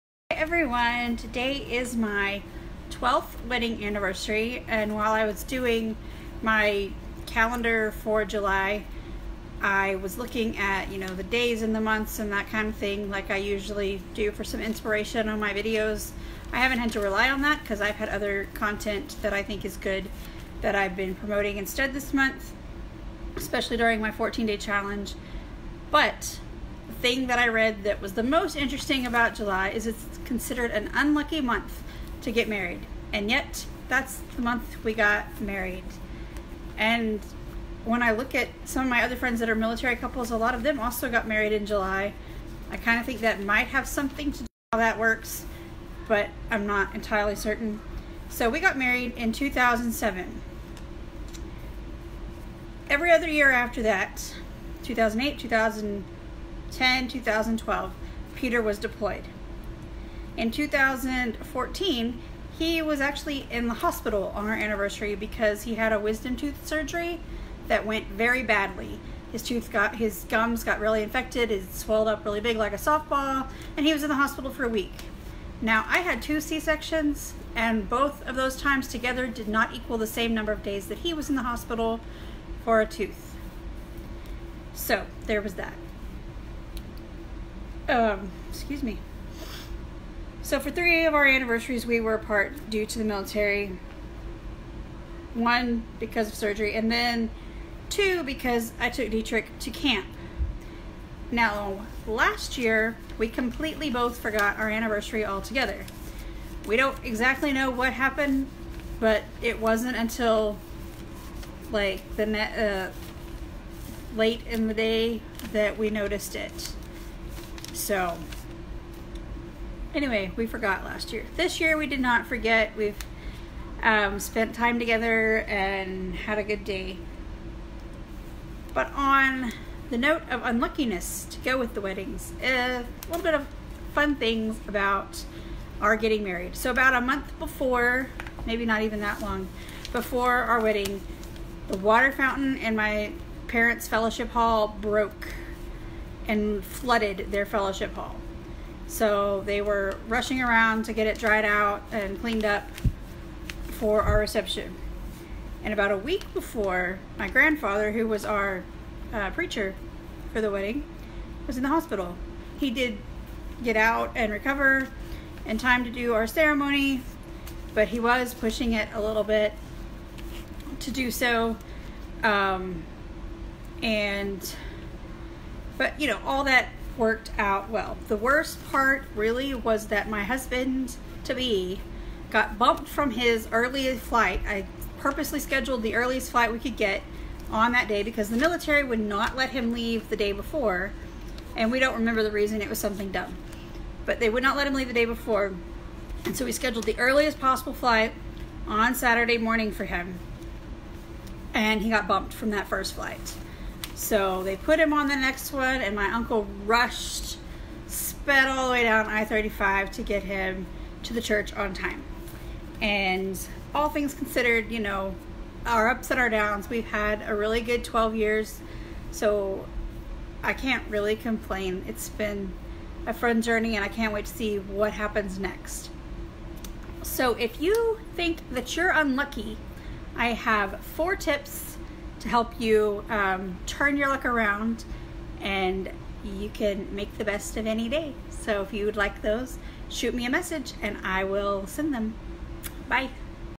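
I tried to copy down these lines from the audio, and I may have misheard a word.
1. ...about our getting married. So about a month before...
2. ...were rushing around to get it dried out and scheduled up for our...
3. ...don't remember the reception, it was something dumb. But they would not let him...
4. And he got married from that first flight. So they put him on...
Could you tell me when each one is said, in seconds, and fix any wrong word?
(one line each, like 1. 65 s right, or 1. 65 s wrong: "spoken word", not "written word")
1. 134 s right
2. 149 s wrong: "cleaned", not "scheduled"
3. 191 s wrong: "reason", not "reception"
4. 201 s wrong: "bumped", not "married".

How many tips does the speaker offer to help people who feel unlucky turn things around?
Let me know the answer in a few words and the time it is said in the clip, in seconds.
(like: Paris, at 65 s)
4, at 230 s.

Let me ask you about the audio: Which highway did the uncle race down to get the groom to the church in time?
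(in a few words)
I-35.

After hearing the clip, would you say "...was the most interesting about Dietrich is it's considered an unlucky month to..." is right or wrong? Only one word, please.
wrong.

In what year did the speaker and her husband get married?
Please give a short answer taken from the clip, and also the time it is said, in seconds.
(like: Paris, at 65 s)
2007, at 49 s.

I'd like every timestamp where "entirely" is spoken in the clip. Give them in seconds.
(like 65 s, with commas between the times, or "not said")
46 s.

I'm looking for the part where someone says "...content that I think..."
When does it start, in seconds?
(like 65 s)
18 s.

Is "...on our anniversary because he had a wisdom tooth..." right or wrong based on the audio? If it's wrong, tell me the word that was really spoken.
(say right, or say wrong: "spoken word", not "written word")
right.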